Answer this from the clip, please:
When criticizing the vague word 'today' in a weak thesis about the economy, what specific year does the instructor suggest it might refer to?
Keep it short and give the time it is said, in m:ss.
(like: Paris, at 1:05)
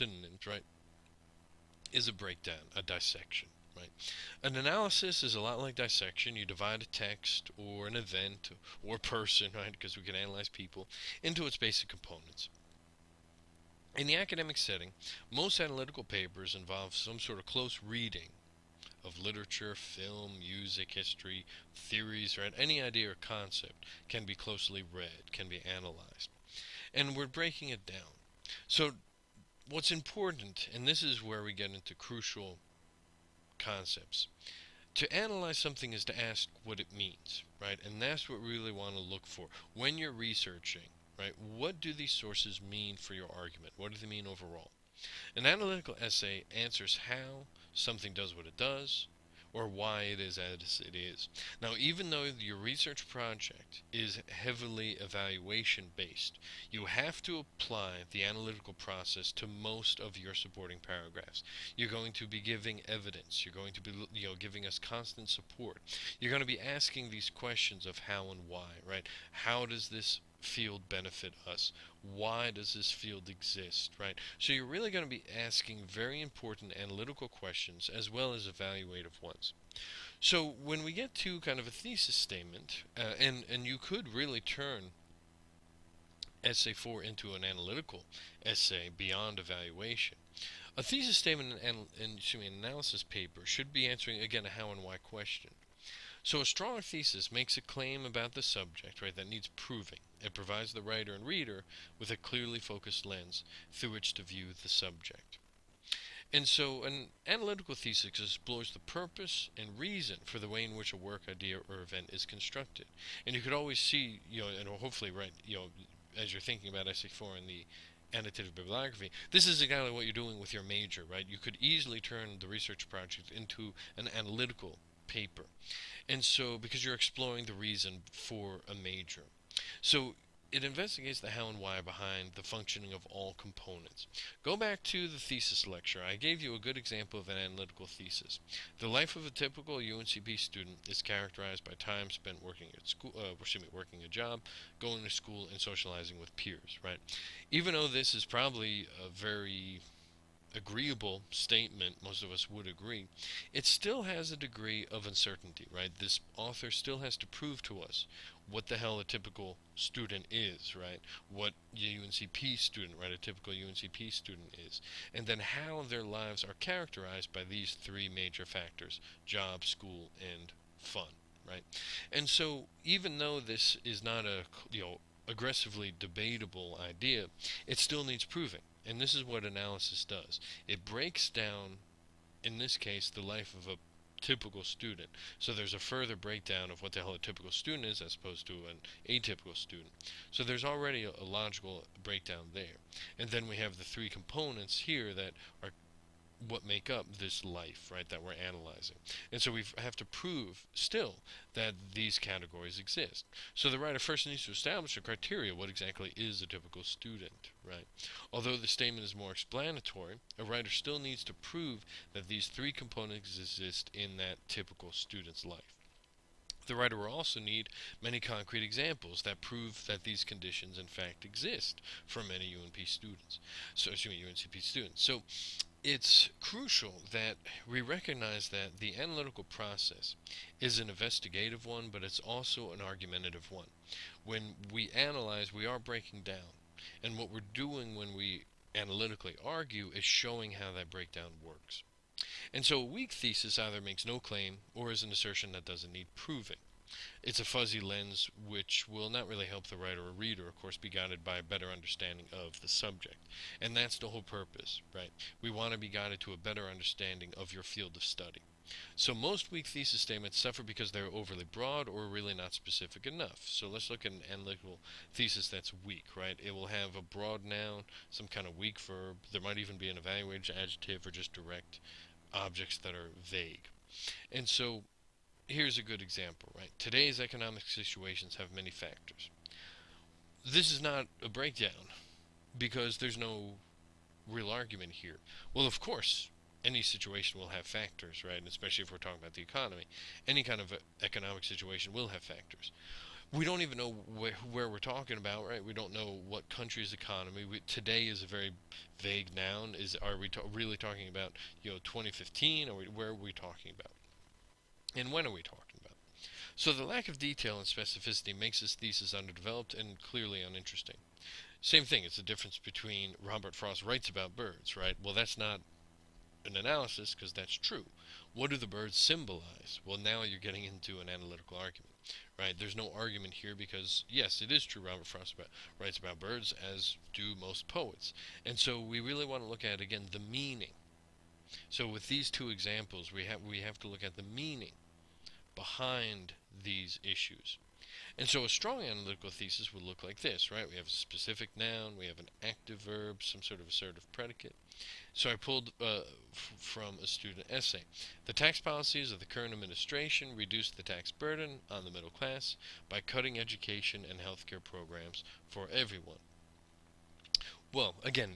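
2015, at 5:01.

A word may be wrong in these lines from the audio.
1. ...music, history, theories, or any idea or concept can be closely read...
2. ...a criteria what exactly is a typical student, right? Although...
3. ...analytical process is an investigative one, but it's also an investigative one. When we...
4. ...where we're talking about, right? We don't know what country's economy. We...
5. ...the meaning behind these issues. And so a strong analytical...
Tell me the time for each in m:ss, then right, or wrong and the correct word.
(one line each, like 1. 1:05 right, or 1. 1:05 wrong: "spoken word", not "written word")
1. 0:20 right
2. 3:24 right
3. 3:48 wrong: "argumentative", not "investigative"
4. 4:54 right
5. 5:34 right.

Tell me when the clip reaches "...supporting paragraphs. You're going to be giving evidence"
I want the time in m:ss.
1:00.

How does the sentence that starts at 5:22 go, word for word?
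There's no argument here because, yes, it is true Robert Frost about, writes about birds, as do most poets.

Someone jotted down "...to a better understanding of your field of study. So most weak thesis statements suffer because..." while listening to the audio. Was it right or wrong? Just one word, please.
right.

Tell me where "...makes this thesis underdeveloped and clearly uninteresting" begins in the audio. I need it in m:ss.
5:08.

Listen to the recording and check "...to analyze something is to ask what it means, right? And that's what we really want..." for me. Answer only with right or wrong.
right.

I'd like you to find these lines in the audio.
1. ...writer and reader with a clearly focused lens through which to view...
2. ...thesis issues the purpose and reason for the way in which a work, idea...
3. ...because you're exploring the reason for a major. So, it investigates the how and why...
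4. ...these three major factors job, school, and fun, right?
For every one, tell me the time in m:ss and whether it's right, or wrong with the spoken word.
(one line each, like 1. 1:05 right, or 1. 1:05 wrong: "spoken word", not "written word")
1. 1:40 right
2. 1:47 wrong: "explores", not "issues"
3. 2:06 right
4. 2:47 right.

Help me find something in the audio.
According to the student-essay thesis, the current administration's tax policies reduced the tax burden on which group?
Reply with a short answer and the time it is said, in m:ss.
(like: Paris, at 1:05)
the middle class, at 5:51.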